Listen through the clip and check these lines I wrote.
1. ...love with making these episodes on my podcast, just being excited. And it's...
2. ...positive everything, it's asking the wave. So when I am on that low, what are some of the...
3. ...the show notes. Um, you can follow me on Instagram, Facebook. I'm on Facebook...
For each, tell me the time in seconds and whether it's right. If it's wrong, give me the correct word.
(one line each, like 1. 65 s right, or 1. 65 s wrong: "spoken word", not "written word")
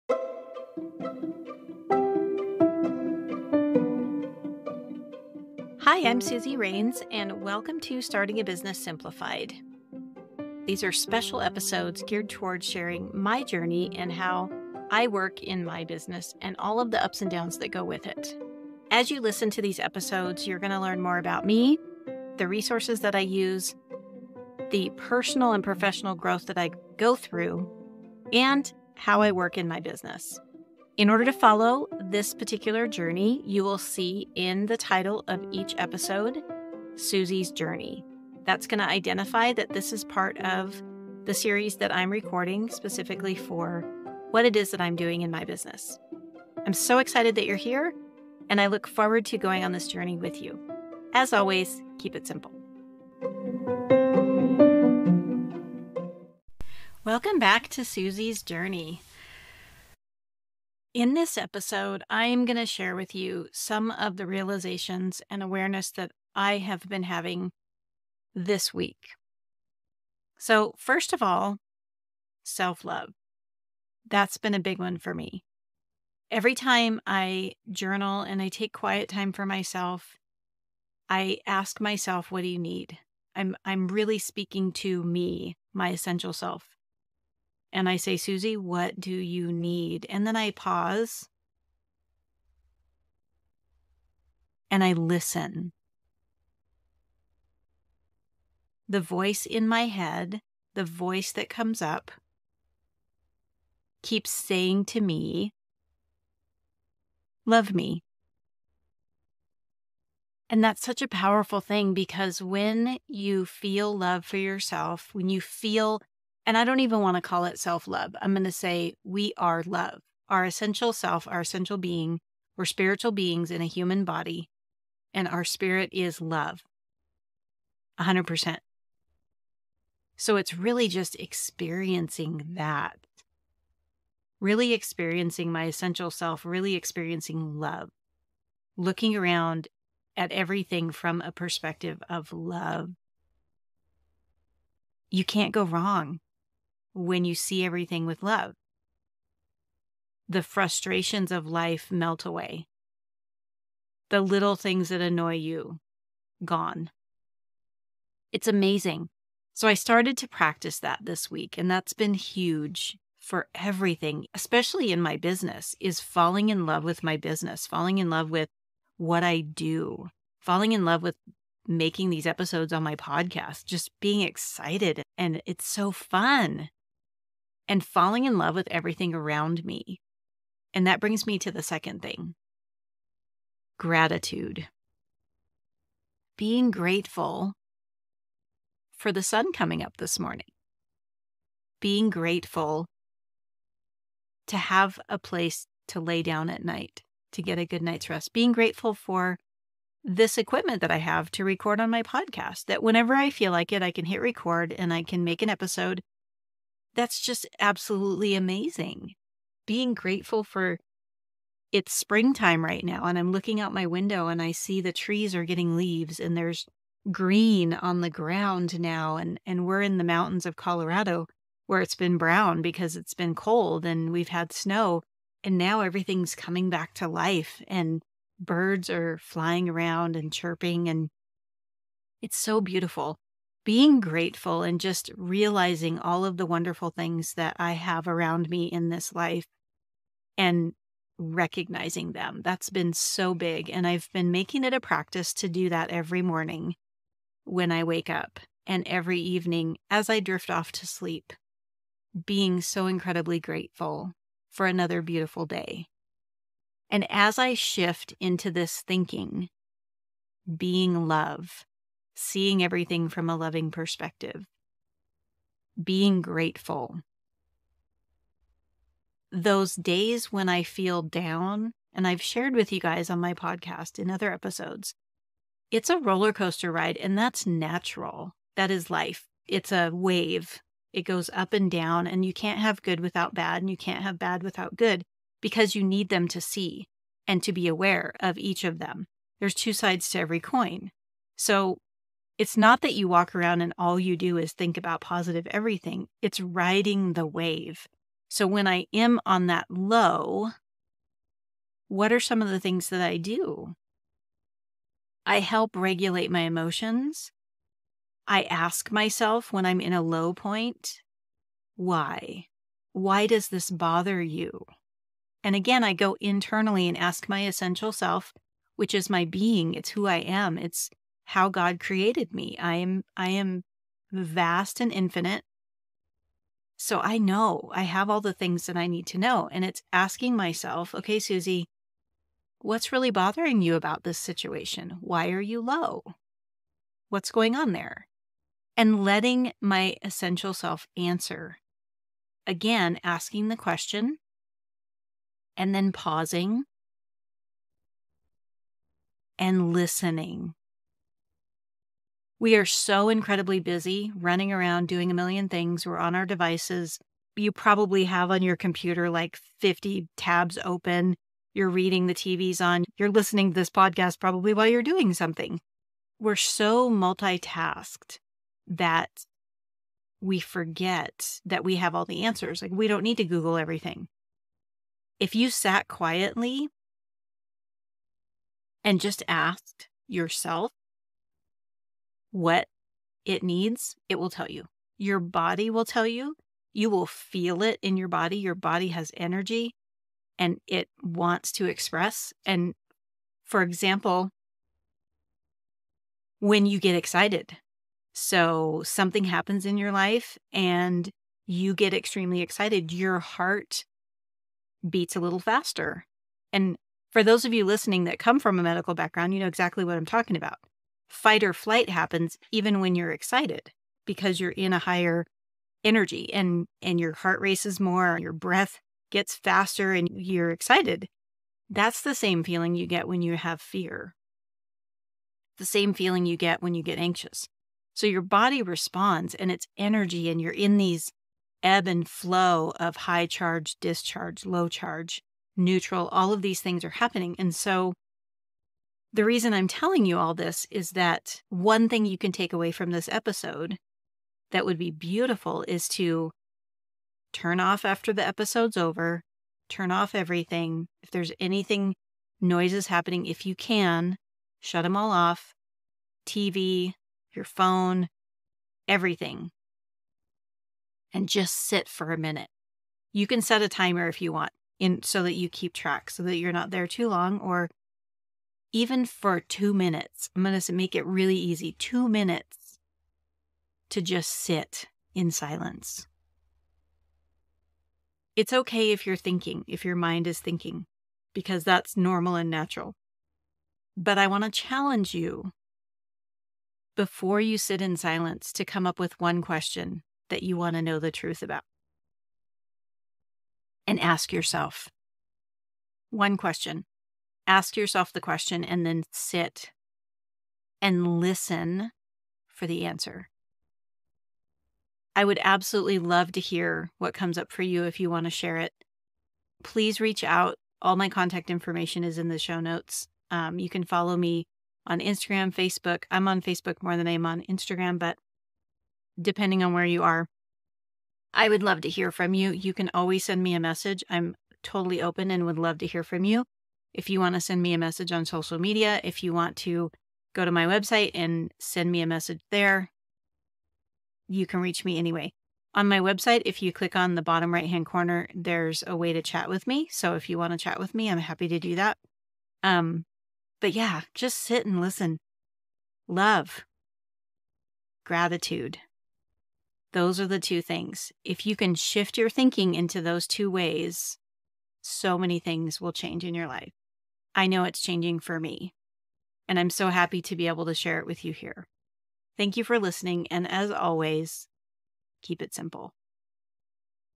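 1. 170 s right
2. 294 s wrong: "riding", not "asking"
3. 512 s right.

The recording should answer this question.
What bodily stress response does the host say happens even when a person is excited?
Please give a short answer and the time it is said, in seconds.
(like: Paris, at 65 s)
Fight or flight, at 411 s.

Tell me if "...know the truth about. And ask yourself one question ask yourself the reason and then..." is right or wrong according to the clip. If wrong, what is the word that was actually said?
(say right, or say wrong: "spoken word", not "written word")
wrong: "question", not "reason".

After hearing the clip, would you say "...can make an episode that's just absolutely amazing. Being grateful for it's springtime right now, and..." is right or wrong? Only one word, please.
right.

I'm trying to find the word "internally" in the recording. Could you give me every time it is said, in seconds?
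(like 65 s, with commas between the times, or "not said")
316 s.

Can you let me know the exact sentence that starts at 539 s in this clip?
So if you want to chat with me, I'm happy to do that.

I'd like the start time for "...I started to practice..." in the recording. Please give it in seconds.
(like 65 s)
159 s.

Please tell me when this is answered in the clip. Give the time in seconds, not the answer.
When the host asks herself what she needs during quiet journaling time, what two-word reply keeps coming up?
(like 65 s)
107 s.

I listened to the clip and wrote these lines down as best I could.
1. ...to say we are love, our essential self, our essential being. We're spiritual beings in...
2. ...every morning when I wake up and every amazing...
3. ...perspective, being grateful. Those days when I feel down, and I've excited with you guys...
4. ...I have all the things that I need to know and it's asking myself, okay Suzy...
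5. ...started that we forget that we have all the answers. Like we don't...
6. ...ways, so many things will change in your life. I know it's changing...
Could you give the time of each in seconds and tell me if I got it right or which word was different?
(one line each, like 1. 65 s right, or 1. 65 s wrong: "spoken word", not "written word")
1. 118 s right
2. 245 s wrong: "evening", not "amazing"
3. 263 s wrong: "shared", not "excited"
4. 327 s right
5. 366 s wrong: "multitasked", not "started"
6. 553 s right.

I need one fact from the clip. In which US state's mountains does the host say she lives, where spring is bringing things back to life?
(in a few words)
Colorado.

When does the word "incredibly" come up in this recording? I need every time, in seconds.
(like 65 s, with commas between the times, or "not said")
252 s, 353 s.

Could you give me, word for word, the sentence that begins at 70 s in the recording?
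So, first of all, self love.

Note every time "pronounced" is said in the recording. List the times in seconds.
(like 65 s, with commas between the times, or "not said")
not said.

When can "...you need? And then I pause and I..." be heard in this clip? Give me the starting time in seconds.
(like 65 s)
89 s.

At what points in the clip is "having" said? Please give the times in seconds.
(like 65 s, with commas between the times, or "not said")
67 s.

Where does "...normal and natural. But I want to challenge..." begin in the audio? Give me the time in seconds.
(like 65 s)
481 s.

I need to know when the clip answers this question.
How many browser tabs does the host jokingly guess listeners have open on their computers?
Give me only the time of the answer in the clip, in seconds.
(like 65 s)
359 s.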